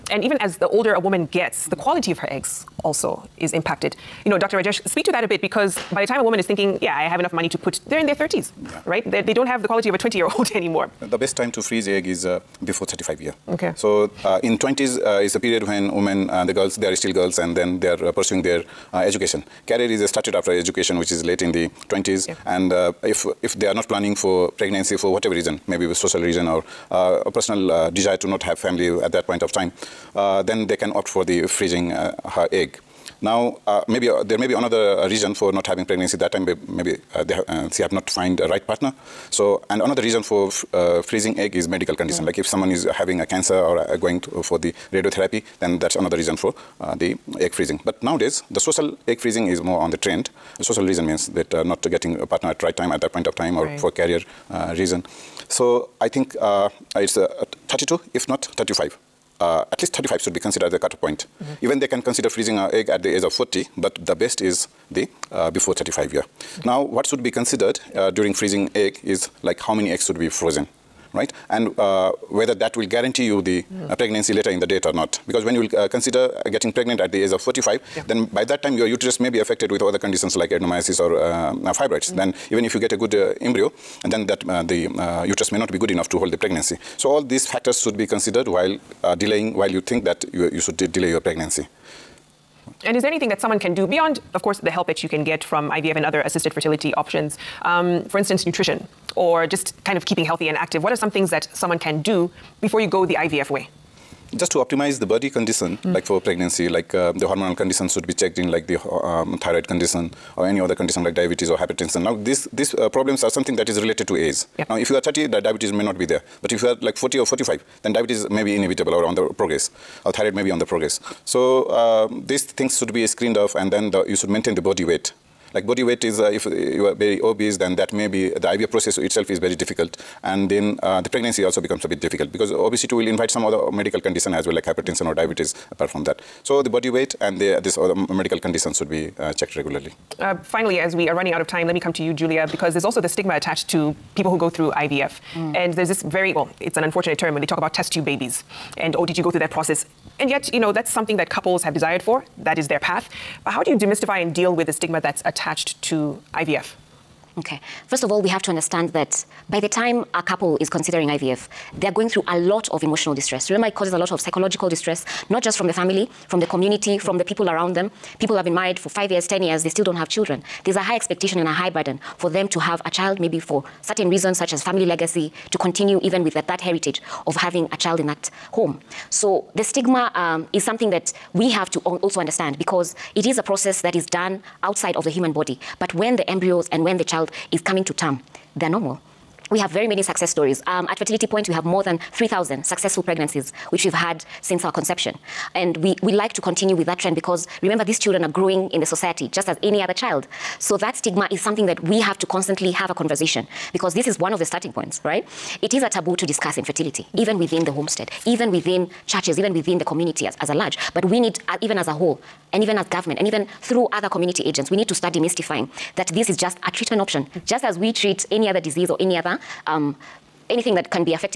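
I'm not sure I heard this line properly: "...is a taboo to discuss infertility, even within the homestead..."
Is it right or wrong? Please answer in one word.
right.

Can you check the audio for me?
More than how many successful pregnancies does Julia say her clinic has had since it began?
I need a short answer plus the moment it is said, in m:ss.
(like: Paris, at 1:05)
3,000, at 3:12.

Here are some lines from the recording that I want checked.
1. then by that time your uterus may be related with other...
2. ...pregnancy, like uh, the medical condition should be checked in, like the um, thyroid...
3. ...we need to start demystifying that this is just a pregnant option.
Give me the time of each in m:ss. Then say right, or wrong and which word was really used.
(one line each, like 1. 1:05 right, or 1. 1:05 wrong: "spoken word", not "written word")
1. 1:18 wrong: "affected", not "related"
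2. 1:46 wrong: "hormonal", not "medical"
3. 3:34 wrong: "treatment", not "pregnant".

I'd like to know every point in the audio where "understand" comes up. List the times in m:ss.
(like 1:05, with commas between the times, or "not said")
2:38, 3:02.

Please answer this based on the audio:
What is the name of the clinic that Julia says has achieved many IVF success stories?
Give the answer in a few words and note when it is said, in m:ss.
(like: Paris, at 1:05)
Fertility Point, at 3:10.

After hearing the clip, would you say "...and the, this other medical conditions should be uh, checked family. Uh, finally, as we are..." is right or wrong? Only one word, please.
wrong.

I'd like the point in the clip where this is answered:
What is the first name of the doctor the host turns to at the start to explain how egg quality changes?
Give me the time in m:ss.
0:04.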